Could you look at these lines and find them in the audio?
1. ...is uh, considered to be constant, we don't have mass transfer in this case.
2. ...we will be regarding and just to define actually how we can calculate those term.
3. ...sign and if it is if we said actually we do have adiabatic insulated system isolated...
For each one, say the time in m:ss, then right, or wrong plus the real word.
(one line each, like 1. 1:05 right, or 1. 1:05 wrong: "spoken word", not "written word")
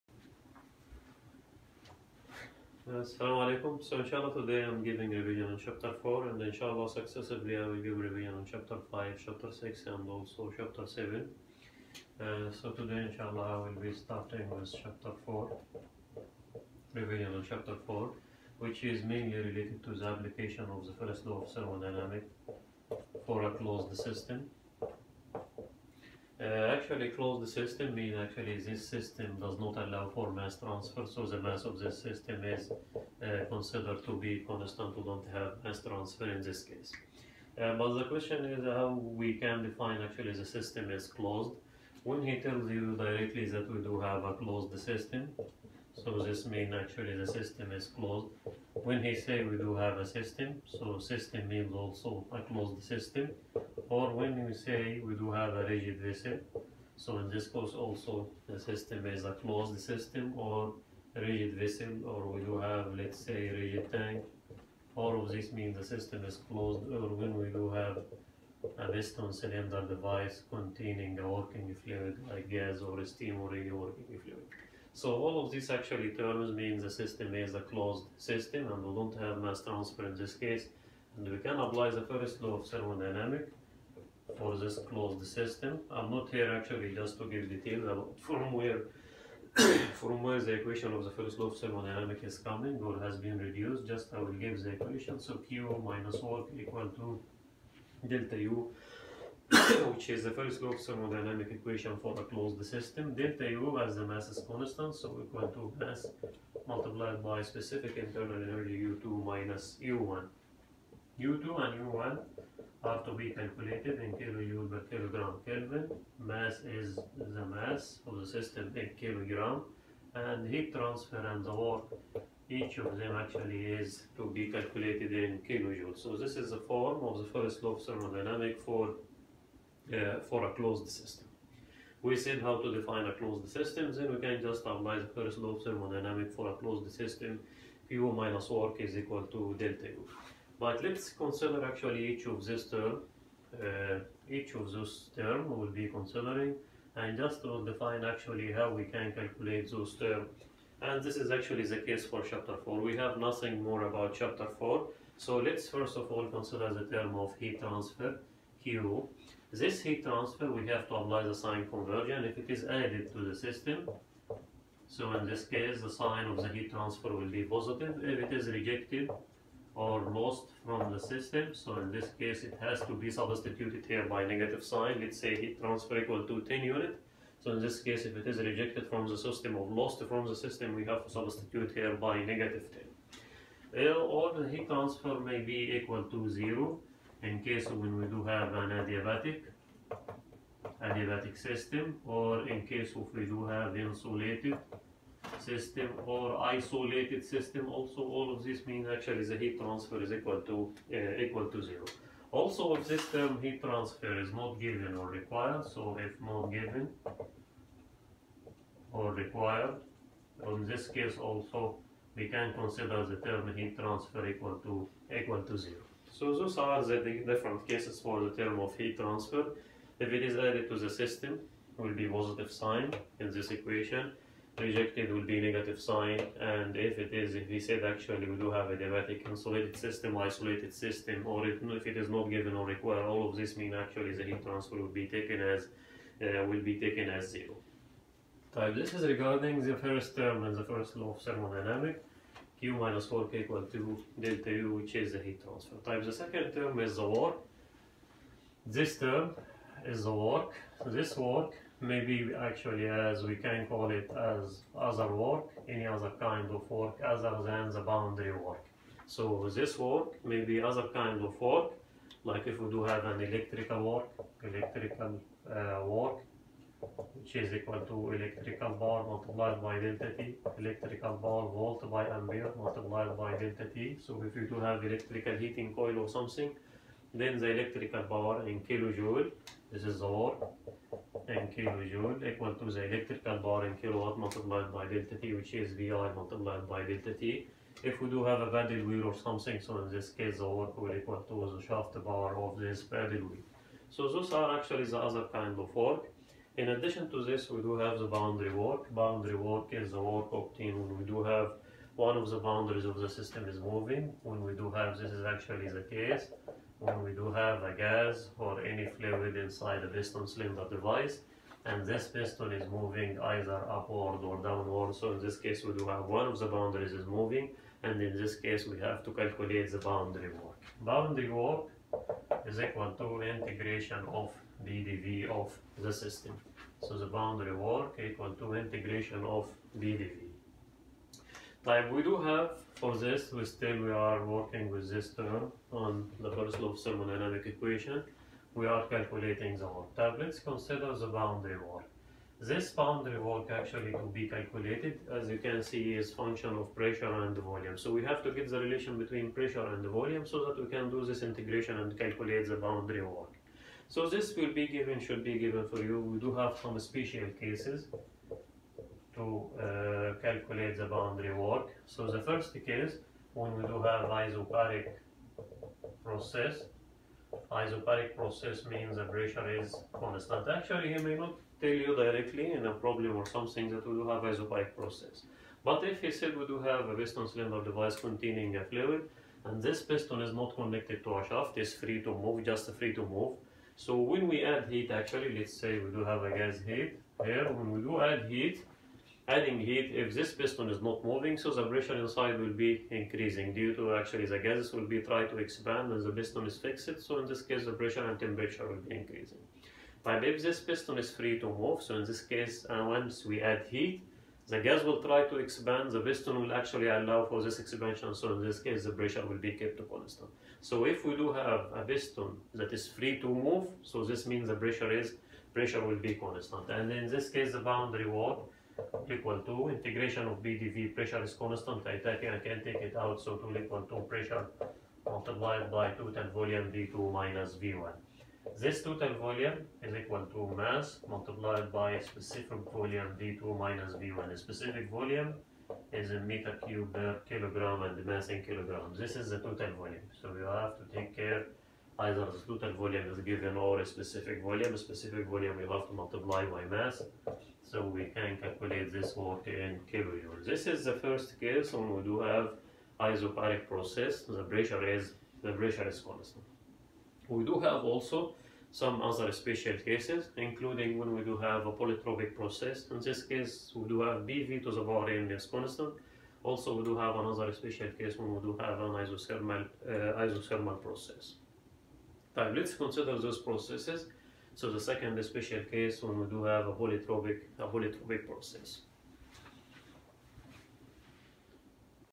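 1. 0:32 right
2. 2:25 wrong: "considering", not "regarding"
3. 3:45 right.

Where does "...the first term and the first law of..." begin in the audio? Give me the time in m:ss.
3:59.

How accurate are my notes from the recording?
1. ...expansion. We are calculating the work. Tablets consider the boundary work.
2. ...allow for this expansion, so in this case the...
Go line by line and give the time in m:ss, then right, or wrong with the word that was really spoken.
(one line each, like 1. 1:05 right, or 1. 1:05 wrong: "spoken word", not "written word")
1. 5:37 wrong: "equation", not "expansion"
2. 6:46 right.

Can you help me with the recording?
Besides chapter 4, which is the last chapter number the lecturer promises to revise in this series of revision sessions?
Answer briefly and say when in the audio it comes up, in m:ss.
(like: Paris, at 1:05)
7, at 0:10.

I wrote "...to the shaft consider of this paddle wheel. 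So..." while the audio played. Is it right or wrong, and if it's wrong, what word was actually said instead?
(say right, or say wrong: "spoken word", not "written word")
wrong: "power", not "consider".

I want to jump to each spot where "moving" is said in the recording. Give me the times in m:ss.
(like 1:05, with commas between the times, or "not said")
5:03, 5:12, 5:17, 6:31.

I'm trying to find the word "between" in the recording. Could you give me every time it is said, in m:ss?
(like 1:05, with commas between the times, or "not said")
5:48.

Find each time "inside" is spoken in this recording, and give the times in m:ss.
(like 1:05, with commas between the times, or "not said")
5:09, 6:31.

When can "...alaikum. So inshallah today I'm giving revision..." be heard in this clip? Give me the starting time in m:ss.
0:03.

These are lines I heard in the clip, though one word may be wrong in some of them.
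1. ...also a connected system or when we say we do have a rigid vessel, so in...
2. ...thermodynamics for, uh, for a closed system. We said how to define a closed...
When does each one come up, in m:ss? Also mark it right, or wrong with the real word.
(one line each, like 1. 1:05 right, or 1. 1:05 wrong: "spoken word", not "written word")
1. 0:51 wrong: "closed", not "connected"
2. 2:07 right.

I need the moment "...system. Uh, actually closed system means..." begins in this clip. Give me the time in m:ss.
0:23.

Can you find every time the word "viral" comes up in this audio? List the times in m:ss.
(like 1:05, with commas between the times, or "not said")
not said.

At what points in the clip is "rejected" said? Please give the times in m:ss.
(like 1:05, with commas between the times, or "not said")
2:48, 2:58, 3:44.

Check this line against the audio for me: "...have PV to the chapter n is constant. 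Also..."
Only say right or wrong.
wrong.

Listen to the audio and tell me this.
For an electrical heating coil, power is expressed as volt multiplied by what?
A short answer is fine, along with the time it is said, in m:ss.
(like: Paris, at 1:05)
ampere, at 4:32.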